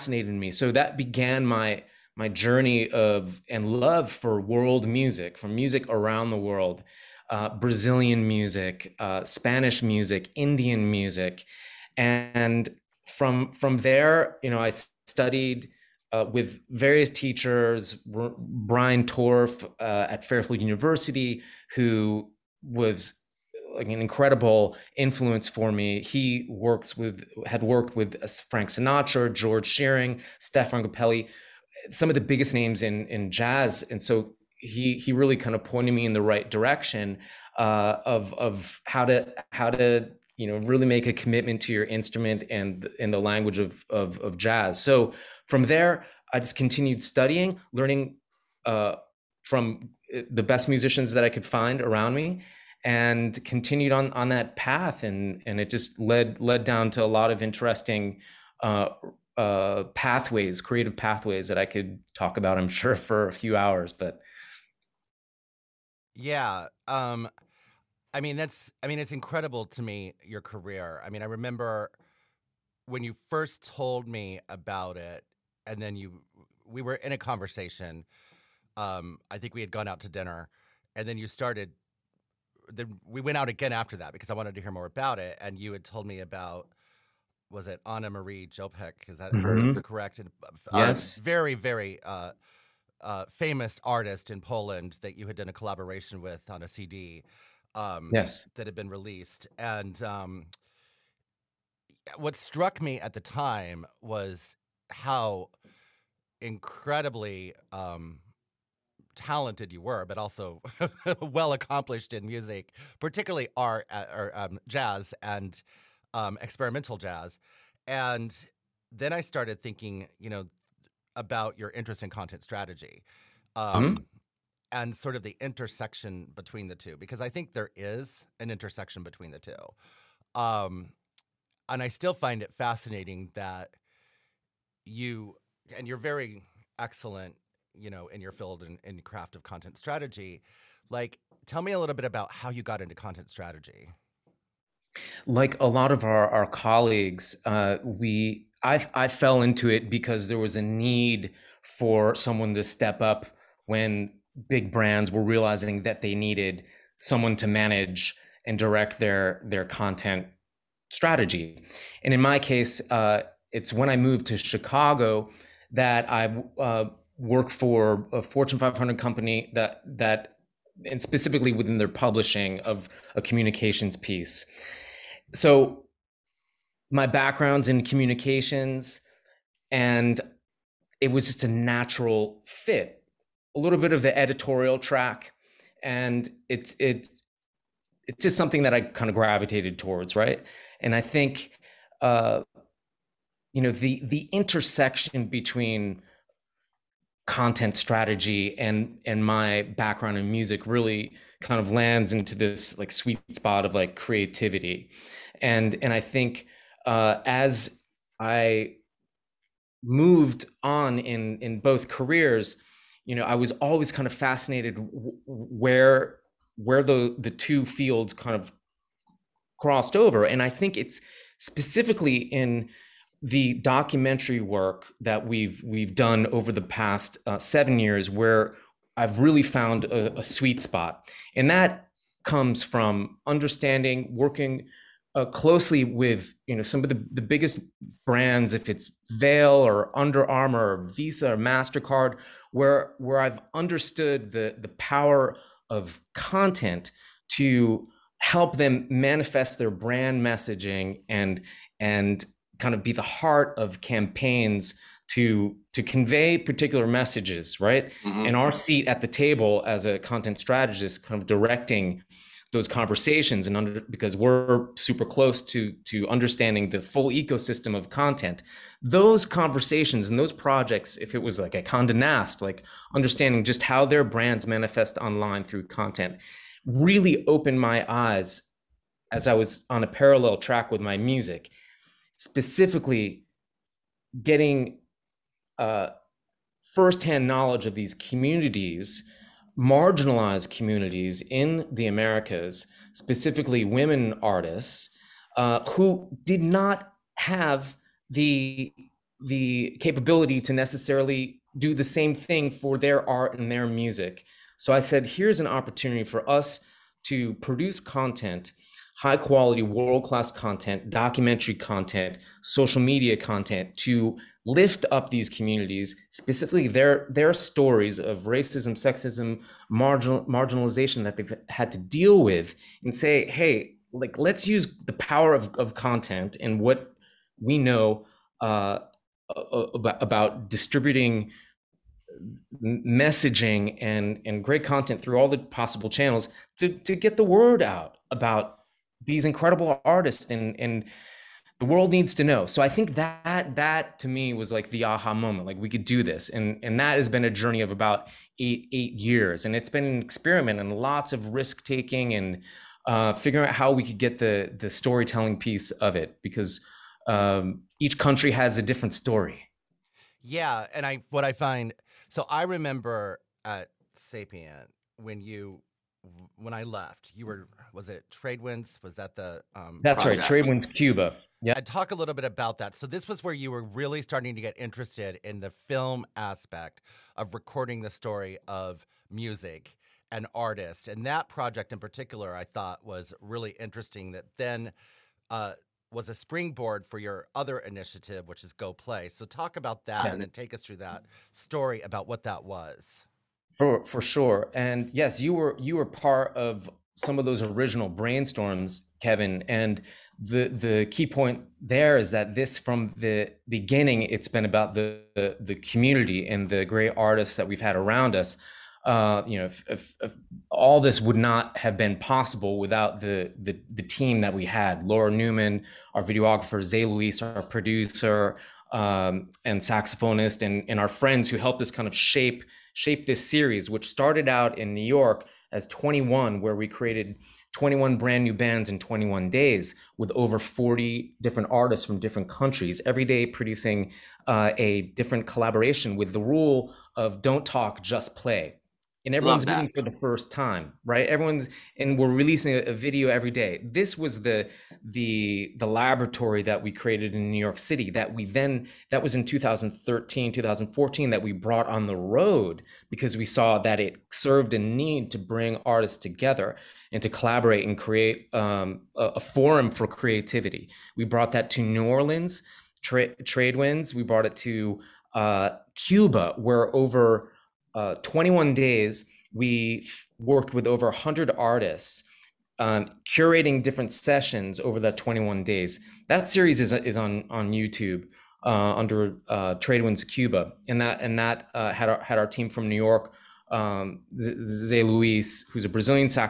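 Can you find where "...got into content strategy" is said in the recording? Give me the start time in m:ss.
2:22.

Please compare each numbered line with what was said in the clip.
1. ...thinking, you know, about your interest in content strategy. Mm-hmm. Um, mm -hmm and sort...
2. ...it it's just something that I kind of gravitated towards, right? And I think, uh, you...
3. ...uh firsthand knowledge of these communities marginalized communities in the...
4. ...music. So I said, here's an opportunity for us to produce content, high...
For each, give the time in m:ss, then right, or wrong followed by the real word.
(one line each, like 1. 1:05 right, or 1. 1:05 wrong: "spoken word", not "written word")
1. 1:59 right
2. 3:06 right
3. 4:45 right
4. 5:03 right.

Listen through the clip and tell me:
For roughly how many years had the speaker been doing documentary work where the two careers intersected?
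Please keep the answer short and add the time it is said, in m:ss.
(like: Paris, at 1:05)
7, at 3:47.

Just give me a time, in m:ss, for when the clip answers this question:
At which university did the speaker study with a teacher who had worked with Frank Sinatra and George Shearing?
0:20.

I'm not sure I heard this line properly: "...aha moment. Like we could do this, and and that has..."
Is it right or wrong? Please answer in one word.
right.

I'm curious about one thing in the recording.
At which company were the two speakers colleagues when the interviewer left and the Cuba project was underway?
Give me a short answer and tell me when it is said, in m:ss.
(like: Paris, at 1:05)
Sapient, at 6:03.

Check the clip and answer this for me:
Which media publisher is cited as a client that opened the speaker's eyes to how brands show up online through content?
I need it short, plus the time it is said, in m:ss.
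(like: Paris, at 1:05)
Condé Nast, at 4:31.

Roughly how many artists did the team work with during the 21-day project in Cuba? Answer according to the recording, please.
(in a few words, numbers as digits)
100.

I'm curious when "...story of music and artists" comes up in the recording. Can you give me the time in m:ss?
6:17.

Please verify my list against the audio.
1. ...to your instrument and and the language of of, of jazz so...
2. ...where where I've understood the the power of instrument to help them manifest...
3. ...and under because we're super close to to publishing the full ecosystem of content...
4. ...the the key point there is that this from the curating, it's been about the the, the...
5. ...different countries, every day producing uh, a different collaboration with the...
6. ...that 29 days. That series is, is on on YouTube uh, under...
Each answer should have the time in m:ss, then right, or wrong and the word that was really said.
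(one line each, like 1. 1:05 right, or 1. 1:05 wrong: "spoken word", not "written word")
1. 0:41 right
2. 4:02 wrong: "content", not "instrument"
3. 4:23 wrong: "understanding", not "publishing"
4. 6:40 wrong: "beginning", not "curating"
5. 7:11 right
6. 7:54 wrong: "21", not "29".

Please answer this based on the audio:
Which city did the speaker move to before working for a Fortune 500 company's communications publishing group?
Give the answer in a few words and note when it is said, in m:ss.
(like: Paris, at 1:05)
Chicago, at 2:44.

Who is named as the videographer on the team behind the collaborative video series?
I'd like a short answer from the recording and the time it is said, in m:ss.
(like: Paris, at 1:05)
Laura Newman, at 6:54.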